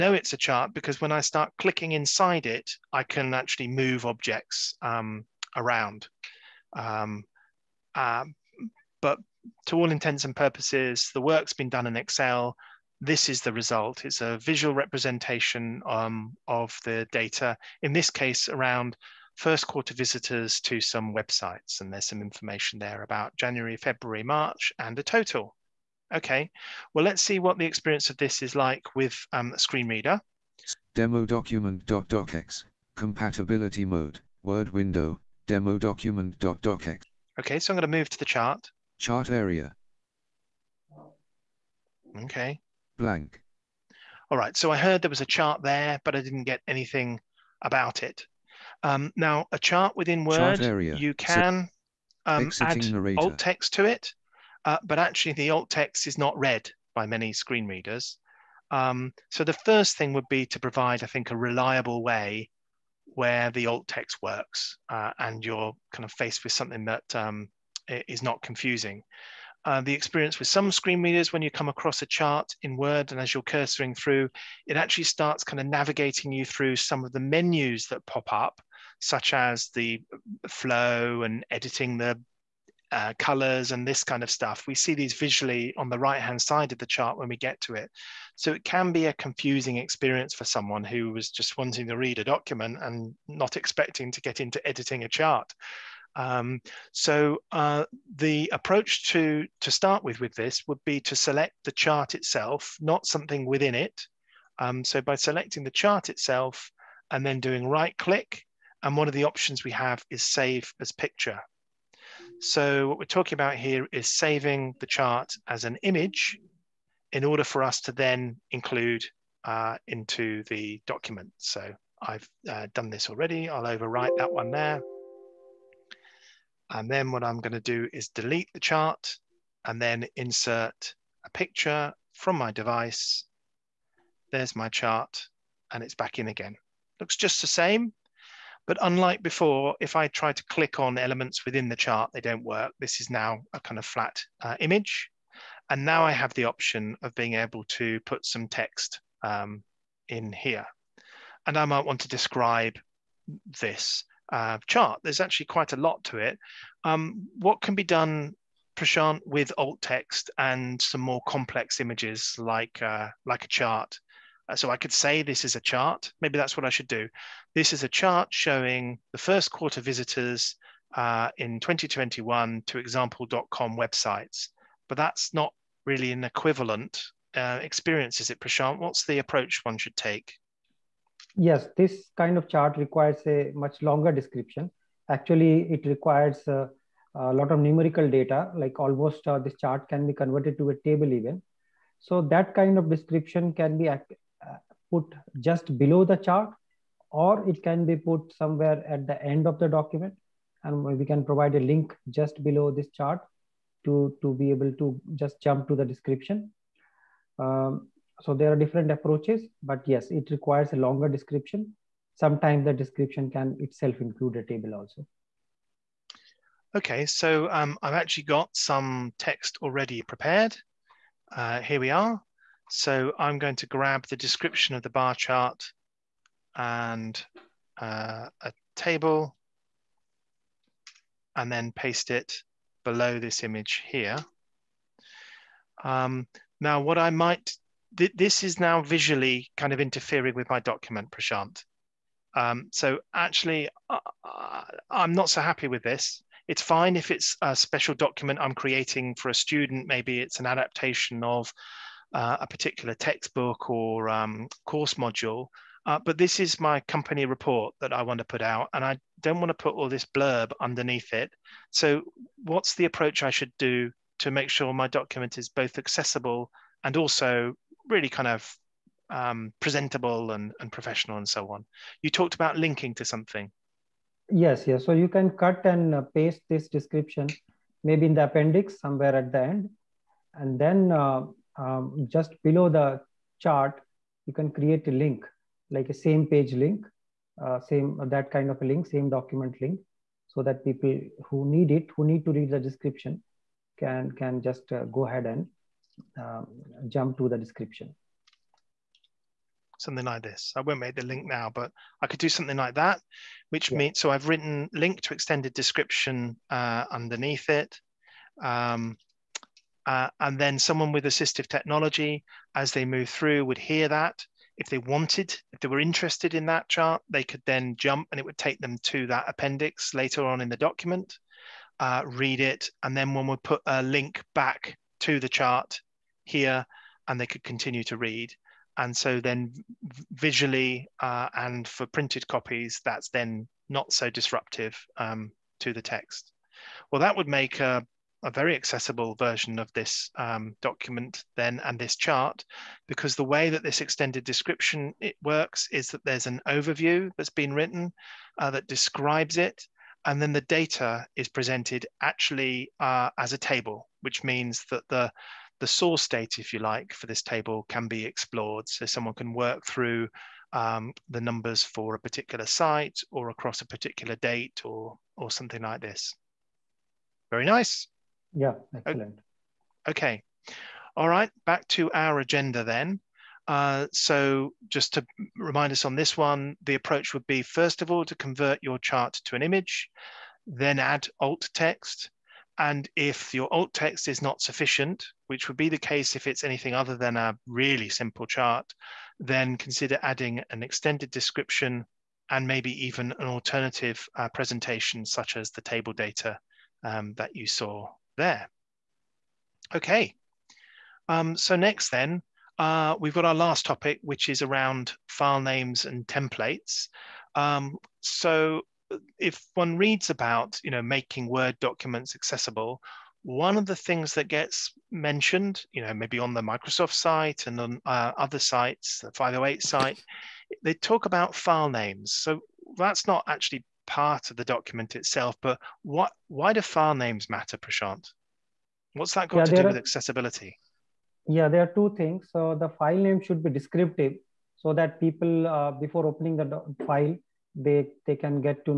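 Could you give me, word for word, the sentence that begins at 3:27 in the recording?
Um, so there are different approaches, but yes, it requires a longer description.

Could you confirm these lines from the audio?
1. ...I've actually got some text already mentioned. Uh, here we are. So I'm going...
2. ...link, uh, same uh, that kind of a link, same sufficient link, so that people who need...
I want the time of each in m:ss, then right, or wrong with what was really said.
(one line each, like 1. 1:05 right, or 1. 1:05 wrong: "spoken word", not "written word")
1. 3:37 wrong: "prepared", not "mentioned"
2. 4:46 wrong: "document", not "sufficient".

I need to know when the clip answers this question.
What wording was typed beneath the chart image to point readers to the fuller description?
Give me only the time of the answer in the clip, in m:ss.
5:04.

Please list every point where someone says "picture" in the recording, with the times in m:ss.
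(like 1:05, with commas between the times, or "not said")
1:50, 2:11.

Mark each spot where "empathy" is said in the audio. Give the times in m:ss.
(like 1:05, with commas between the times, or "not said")
not said.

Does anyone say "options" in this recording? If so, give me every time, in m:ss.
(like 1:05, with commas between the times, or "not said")
1:49, 2:26.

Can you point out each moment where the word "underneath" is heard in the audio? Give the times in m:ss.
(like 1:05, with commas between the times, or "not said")
4:20, 5:06.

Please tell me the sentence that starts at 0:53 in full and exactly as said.
alt text to it, uh, but actually the alt text is not read by many screen readers.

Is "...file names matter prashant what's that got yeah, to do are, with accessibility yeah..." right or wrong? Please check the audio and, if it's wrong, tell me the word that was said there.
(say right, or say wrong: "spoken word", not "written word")
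right.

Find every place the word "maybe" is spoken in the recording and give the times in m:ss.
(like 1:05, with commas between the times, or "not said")
2:46, 4:09, 4:37, 6:32, 6:55.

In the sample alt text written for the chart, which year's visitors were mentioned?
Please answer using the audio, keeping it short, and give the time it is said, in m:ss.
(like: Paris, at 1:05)
2021, at 2:51.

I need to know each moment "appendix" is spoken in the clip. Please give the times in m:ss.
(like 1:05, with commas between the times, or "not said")
4:38, 5:19.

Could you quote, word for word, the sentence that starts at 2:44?
Uh, so I could say this is a chart.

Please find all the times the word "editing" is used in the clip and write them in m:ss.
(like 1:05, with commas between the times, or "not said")
1:21, 1:34.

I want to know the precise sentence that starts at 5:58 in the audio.
So someone can work through um, the numbers for a particular site or across a particular date or, or something like this.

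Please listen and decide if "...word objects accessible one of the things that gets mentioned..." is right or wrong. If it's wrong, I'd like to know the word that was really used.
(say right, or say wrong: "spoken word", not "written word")
wrong: "documents", not "objects".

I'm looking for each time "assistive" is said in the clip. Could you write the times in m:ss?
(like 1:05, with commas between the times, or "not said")
5:11.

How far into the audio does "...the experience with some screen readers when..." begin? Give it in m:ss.
1:09.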